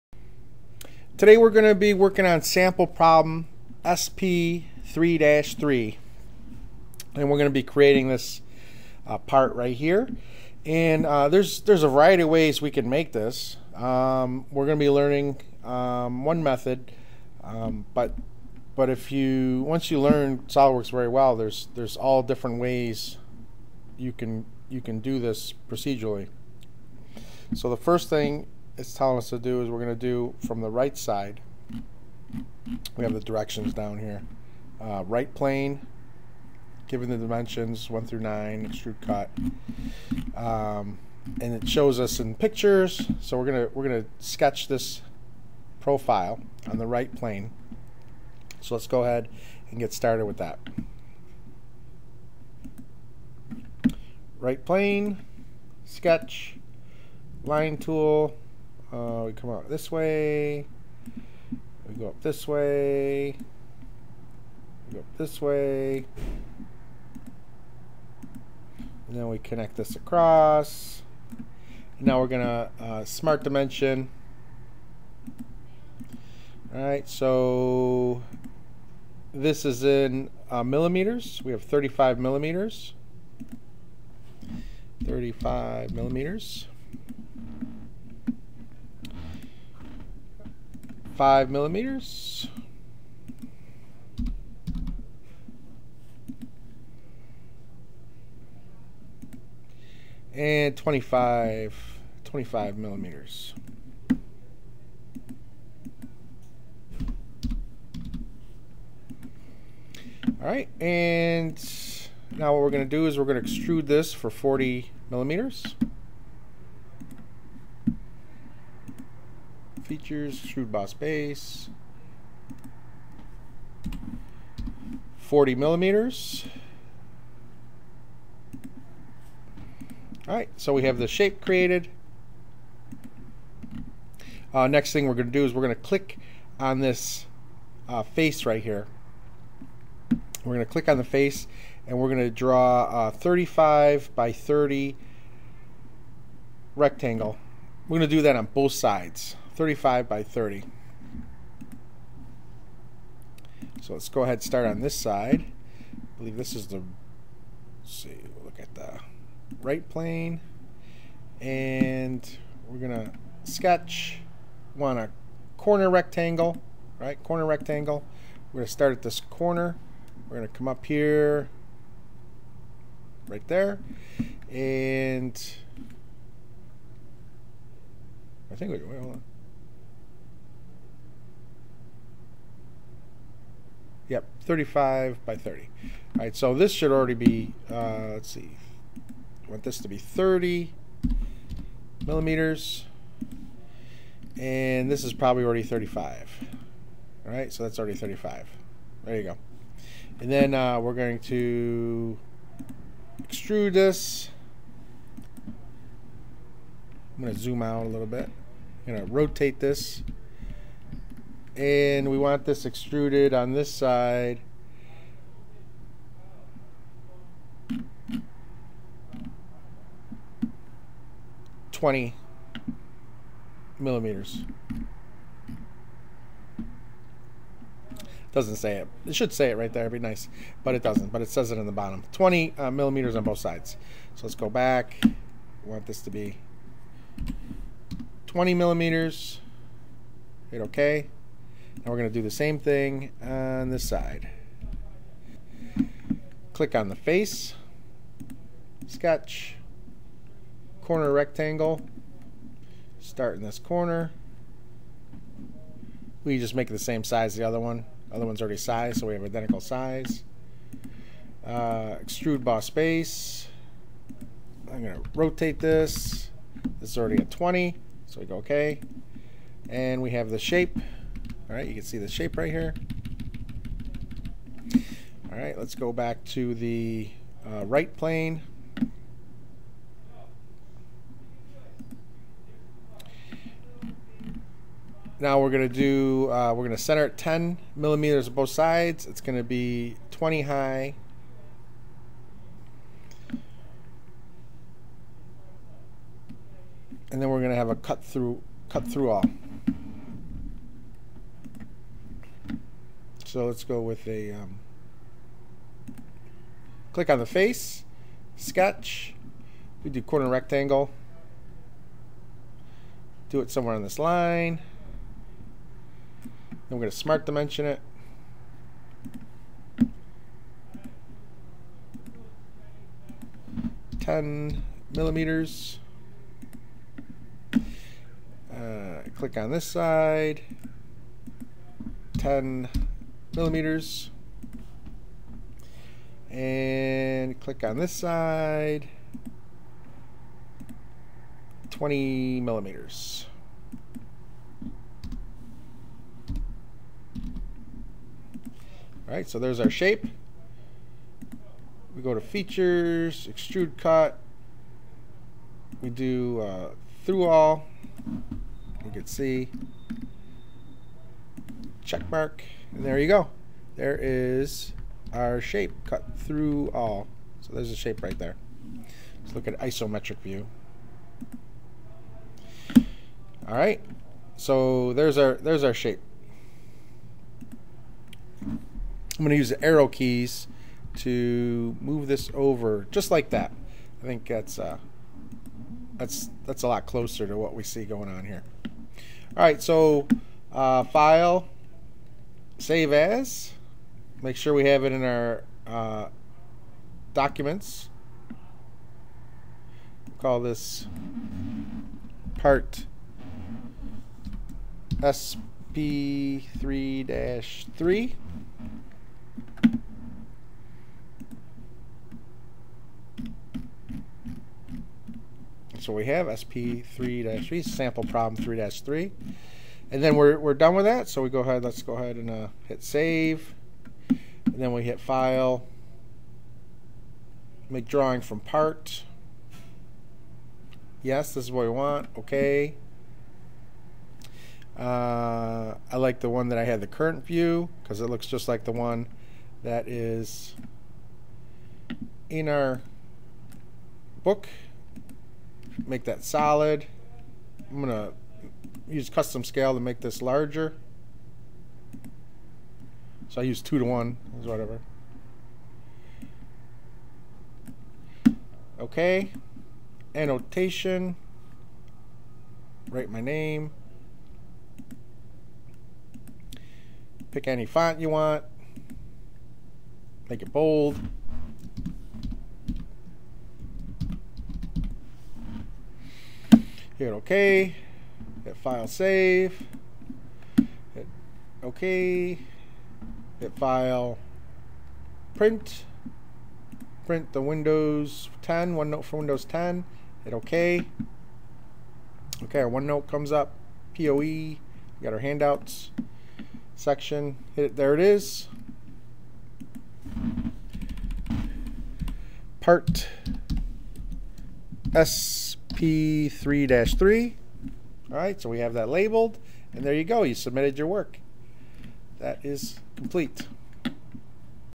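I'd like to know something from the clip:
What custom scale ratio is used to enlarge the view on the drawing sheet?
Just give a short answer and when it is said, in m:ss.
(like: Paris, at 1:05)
2 to 1, at 7:33.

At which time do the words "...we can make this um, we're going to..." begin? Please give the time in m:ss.
0:12.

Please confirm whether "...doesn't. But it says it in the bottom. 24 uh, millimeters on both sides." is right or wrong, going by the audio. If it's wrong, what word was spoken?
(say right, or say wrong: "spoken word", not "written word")
wrong: "20", not "24".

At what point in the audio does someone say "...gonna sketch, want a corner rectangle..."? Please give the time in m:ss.
2:42.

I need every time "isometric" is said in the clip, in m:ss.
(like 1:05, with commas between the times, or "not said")
6:09.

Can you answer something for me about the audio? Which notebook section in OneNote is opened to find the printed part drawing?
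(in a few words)
Handouts.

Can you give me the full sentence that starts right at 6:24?
I think that's uh, that's that's a lot closer to what we see going on here.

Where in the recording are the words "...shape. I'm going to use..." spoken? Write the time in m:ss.
6:15.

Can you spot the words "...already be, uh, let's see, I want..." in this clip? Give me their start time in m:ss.
3:06.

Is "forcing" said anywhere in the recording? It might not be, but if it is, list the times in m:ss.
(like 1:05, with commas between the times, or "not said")
not said.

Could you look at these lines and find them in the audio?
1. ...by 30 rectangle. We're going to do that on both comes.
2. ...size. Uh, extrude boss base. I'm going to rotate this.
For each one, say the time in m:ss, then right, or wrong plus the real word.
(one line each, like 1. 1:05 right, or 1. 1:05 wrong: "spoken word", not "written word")
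1. 2:24 wrong: "sides", not "comes"
2. 4:19 right.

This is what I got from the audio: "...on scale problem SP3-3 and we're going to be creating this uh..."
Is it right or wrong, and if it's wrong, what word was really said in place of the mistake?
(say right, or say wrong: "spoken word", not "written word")
wrong: "sample", not "scale".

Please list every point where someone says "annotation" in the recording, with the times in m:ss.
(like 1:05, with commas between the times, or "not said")
7:40.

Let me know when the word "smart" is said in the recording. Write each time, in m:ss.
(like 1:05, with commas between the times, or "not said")
1:13, 5:16.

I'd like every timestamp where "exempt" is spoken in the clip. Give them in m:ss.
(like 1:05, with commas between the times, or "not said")
not said.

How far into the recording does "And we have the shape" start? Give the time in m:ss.
4:29.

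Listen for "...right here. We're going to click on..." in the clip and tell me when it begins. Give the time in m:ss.
2:18.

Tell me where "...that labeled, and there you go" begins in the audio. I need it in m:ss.
8:28.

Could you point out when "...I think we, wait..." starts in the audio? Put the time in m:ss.
2:58.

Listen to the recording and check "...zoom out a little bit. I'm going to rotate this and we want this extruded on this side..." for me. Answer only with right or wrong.
right.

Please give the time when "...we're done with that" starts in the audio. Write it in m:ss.
7:00.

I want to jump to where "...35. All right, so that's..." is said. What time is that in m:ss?
3:15.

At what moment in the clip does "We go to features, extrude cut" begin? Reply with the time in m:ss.
5:51.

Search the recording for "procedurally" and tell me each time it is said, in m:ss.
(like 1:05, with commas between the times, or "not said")
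0:25.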